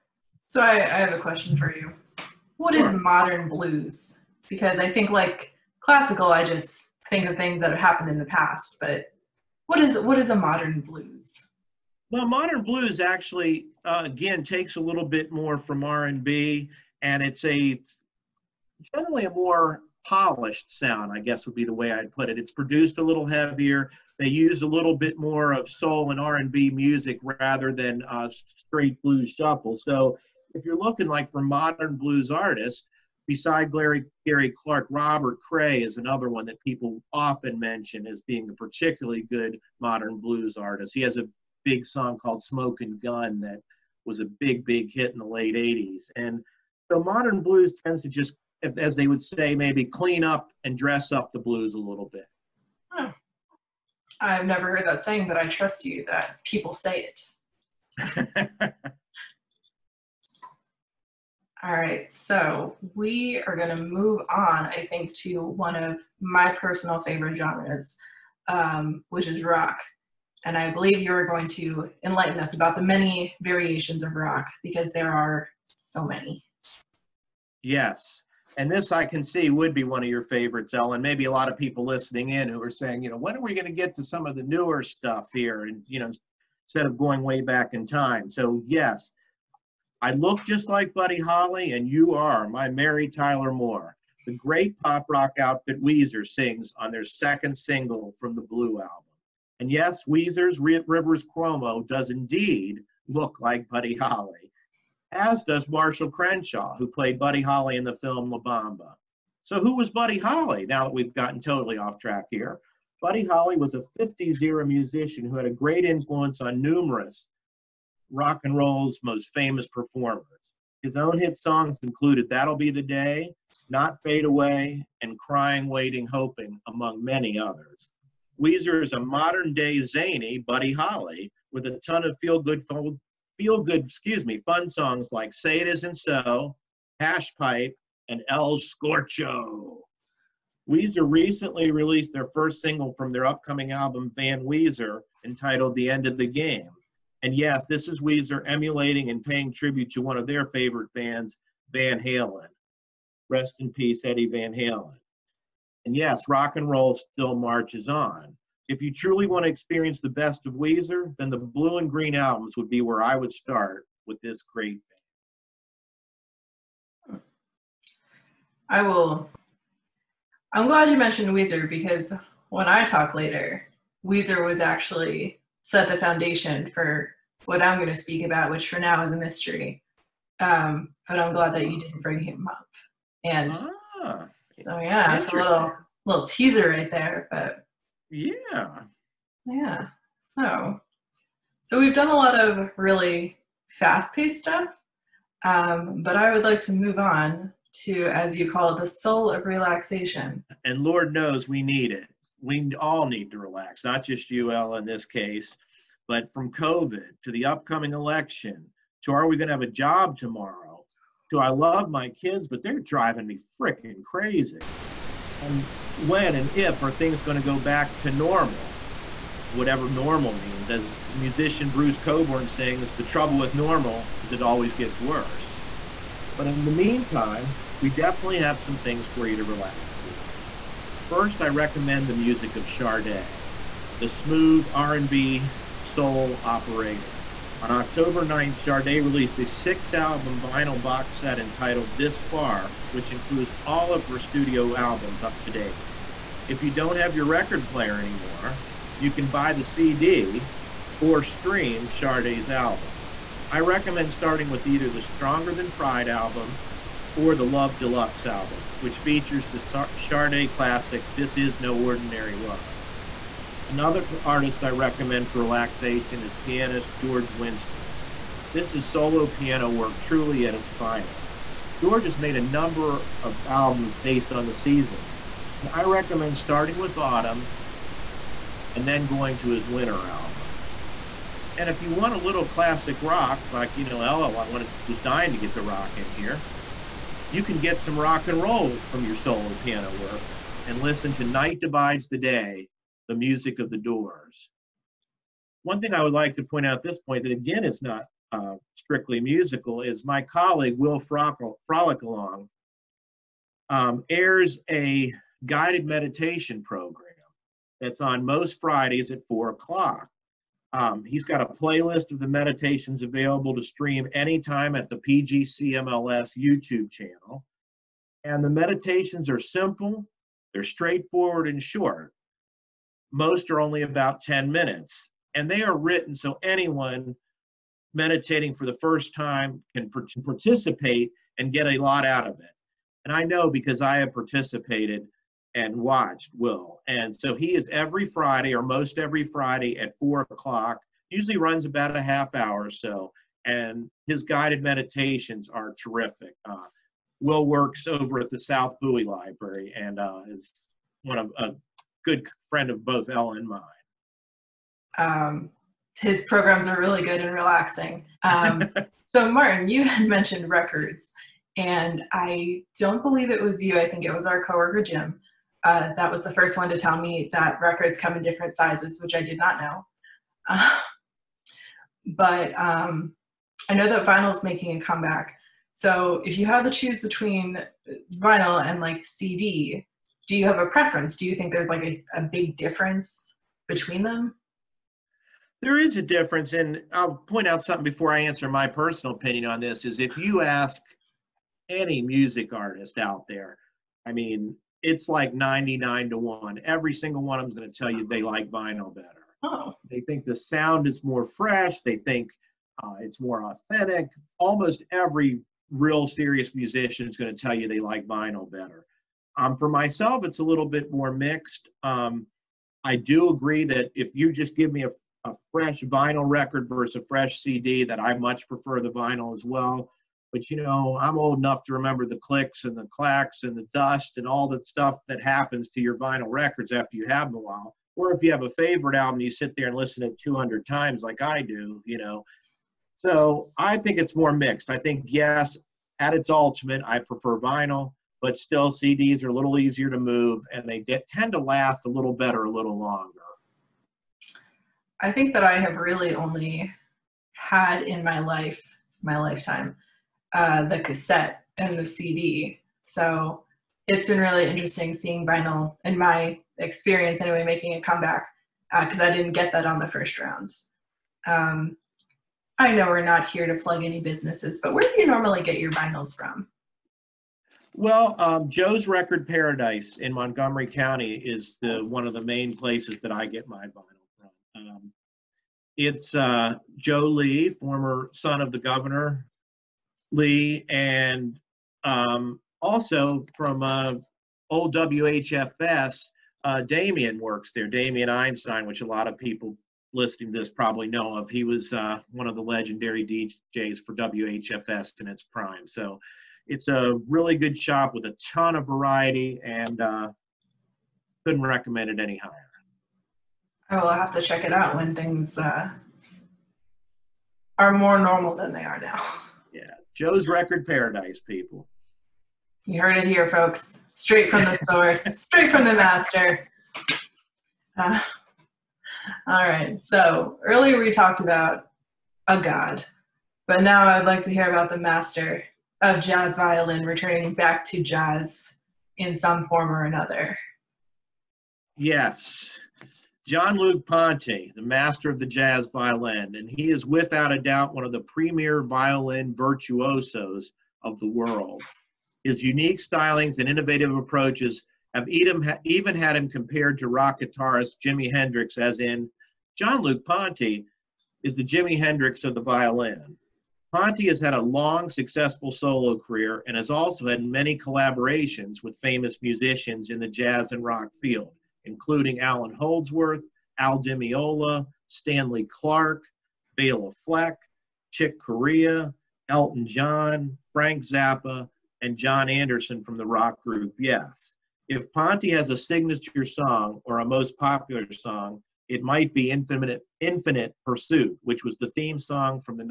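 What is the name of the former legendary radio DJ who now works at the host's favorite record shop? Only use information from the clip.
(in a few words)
Damien Einstein.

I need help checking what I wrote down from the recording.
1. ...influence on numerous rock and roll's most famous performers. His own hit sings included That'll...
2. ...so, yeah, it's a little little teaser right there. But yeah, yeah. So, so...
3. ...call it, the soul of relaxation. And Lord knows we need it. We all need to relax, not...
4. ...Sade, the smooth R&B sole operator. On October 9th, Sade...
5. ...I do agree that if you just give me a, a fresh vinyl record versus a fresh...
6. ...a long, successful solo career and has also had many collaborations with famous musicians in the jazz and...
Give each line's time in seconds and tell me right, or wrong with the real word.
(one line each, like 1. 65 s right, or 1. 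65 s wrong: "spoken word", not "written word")
1. 115 s wrong: "songs", not "sings"
2. 184 s right
3. 198 s right
4. 232 s right
5. 412 s right
6. 554 s right.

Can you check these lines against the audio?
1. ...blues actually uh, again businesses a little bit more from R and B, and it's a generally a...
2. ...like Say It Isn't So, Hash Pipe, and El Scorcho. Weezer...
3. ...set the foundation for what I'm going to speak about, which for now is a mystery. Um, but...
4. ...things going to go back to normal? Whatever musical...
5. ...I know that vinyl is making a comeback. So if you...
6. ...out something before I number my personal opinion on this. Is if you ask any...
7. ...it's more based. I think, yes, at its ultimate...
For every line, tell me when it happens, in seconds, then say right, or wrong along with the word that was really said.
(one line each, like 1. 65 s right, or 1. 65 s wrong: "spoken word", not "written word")
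1. 12 s wrong: "takes", not "businesses"
2. 135 s right
3. 175 s right
4. 216 s wrong: "normal", not "musical"
5. 373 s right
6. 387 s wrong: "answer", not "number"
7. 433 s wrong: "mixed", not "based".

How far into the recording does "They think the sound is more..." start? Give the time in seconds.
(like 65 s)
399 s.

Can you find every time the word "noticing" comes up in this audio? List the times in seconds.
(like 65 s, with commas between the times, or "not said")
not said.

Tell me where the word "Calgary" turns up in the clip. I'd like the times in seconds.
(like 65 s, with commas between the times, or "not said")
not said.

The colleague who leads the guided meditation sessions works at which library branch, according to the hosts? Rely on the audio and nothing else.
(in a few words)
South Bowie Library.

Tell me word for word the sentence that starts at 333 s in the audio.
And I know because I have participated and watched Will.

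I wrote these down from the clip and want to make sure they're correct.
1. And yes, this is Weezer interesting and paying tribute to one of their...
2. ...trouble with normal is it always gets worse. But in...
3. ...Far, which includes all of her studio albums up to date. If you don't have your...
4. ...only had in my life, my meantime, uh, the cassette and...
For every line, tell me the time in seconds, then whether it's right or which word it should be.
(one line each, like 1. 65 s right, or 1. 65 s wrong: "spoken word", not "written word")
1. 147 s wrong: "emulating", not "interesting"
2. 223 s right
3. 242 s right
4. 446 s wrong: "lifetime", not "meantime".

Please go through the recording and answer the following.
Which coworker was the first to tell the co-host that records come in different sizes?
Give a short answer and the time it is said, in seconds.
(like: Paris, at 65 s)
Jim, at 364 s.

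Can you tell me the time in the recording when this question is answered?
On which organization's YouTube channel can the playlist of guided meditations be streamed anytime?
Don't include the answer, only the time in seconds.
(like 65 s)
314 s.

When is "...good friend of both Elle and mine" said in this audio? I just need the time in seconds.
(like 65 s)
352 s.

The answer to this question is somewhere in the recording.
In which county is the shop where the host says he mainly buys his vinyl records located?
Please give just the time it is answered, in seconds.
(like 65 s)
470 s.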